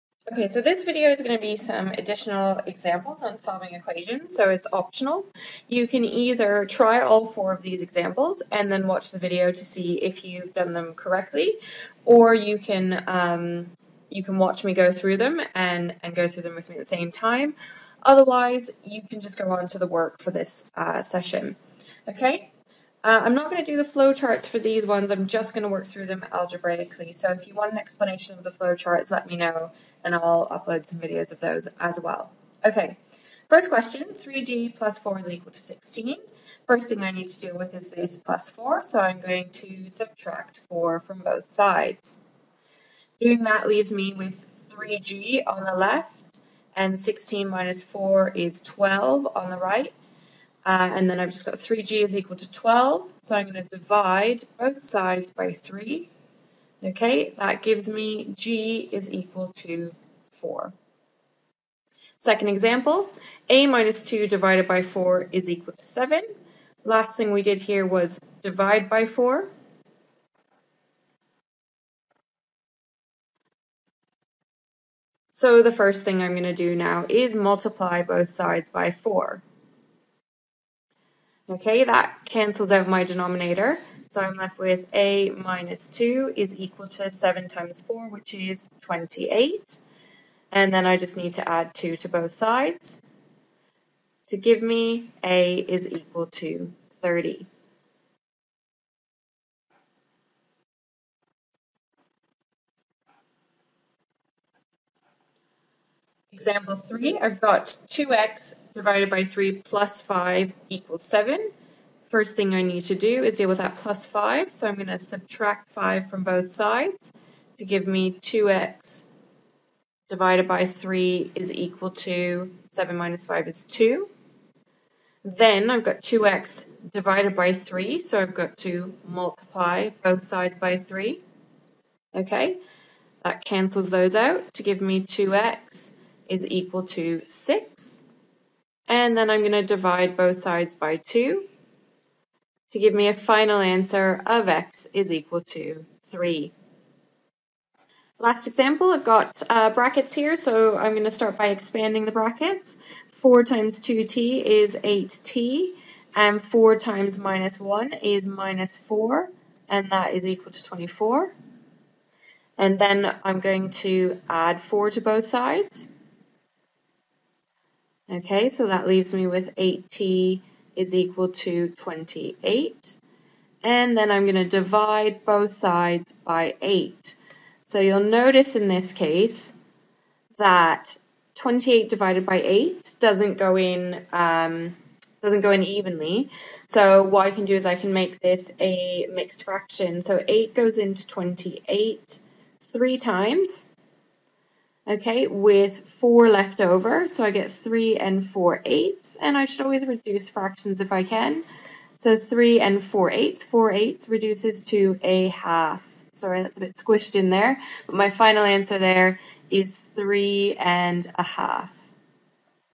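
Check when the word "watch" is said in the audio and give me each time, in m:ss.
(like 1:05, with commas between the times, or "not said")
0:08, 0:14.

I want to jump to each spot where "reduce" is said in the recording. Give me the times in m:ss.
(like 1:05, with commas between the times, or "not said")
3:19, 3:24.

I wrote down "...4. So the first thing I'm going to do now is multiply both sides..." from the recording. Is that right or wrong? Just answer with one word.
right.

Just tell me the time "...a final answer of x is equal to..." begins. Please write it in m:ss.
2:23.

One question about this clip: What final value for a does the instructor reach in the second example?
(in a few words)
30.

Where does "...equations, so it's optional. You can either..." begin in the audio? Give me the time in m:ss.
0:03.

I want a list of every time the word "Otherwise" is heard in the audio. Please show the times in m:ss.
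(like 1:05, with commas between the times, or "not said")
0:18.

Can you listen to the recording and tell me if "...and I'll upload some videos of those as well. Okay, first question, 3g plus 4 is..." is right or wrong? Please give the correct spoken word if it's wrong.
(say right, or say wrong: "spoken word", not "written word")
right.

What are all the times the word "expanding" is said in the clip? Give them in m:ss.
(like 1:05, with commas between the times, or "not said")
2:31.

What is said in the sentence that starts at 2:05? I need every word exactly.
Then I've got 2x divided by 3, so I've got to multiply both sides by 3.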